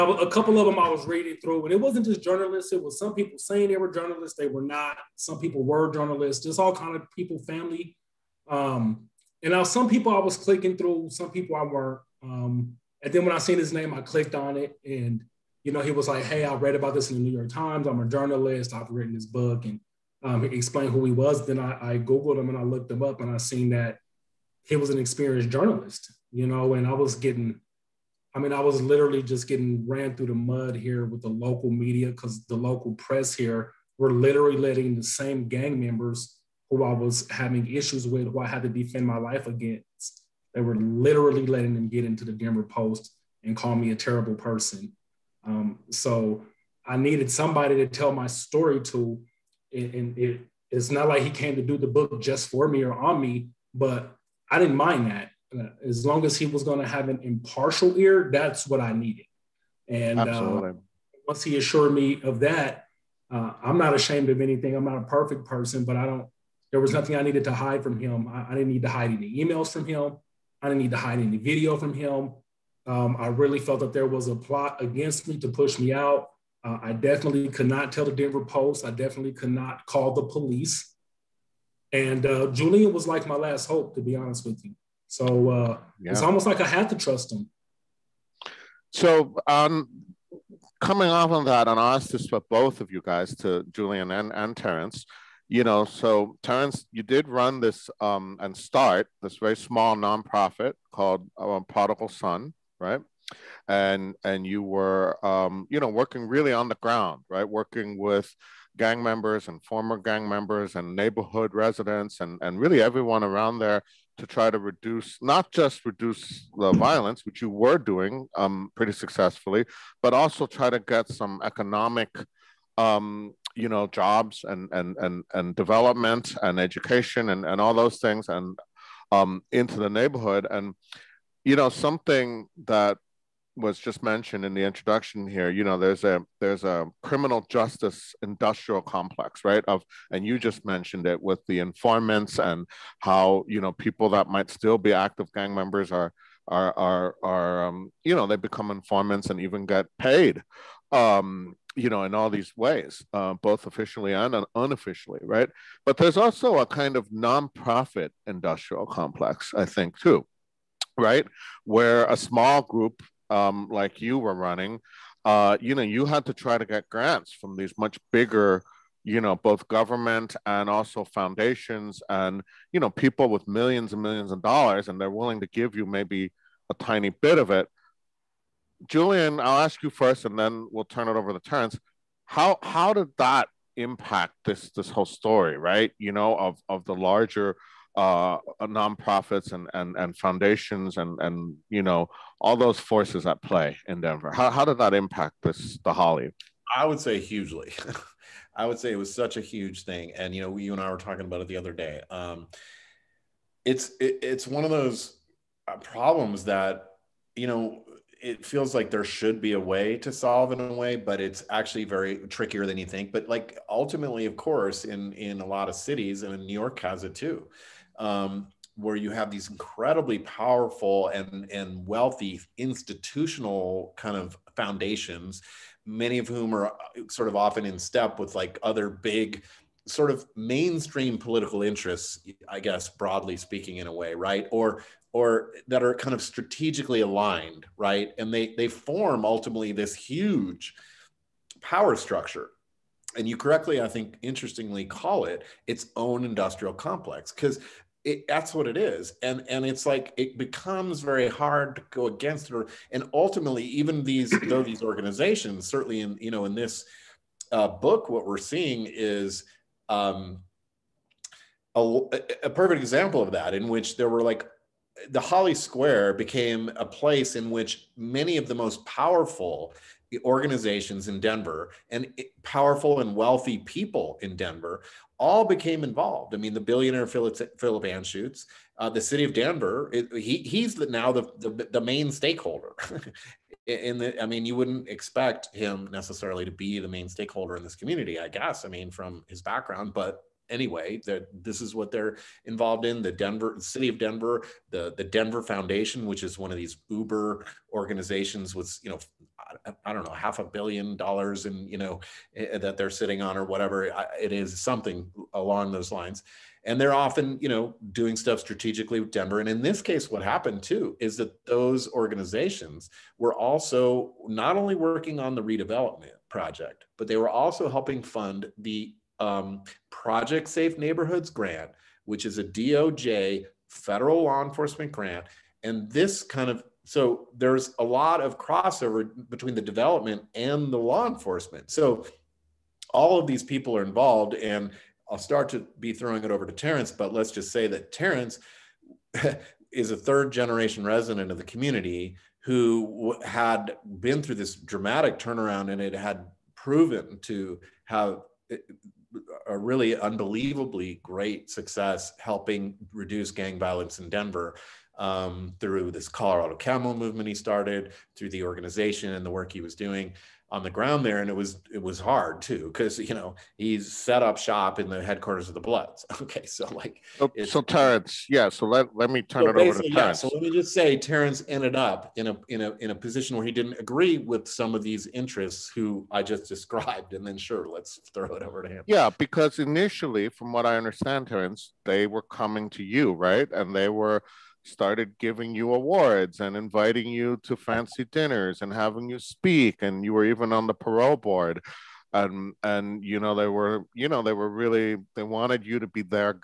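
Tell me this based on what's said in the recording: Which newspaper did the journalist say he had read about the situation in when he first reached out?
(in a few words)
New York Times.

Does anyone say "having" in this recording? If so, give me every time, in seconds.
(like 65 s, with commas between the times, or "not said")
37 s, 388 s.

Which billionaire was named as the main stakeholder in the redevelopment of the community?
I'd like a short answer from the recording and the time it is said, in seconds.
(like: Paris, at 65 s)
Philip Anschutz, at 277 s.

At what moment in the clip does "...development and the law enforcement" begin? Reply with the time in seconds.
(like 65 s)
329 s.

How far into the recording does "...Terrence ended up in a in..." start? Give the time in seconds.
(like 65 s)
370 s.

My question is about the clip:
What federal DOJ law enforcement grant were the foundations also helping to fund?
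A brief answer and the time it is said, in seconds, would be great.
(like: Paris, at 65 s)
Project Safe Neighborhoods, at 319 s.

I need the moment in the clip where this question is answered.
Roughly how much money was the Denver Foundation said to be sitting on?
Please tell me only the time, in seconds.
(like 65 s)
300 s.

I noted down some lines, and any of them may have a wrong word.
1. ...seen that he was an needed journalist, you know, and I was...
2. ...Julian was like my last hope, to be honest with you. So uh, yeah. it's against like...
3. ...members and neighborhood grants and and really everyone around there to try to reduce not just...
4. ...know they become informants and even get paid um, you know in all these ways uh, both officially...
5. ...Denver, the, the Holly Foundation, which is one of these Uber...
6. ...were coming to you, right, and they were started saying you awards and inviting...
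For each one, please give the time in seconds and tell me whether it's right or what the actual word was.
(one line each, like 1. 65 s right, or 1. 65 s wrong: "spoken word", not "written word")
1. 23 s wrong: "experienced", not "needed"
2. 82 s wrong: "almost", not "against"
3. 110 s wrong: "residents", not "grants"
4. 148 s right
5. 293 s wrong: "Denver", not "Holly"
6. 382 s wrong: "giving", not "saying".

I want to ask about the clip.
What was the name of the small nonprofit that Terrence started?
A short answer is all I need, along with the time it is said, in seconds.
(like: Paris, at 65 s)
Prodigal Son, at 101 s.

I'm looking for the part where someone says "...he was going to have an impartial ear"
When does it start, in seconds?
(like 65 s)
56 s.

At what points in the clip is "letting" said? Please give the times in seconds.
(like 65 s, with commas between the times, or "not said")
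34 s, 41 s.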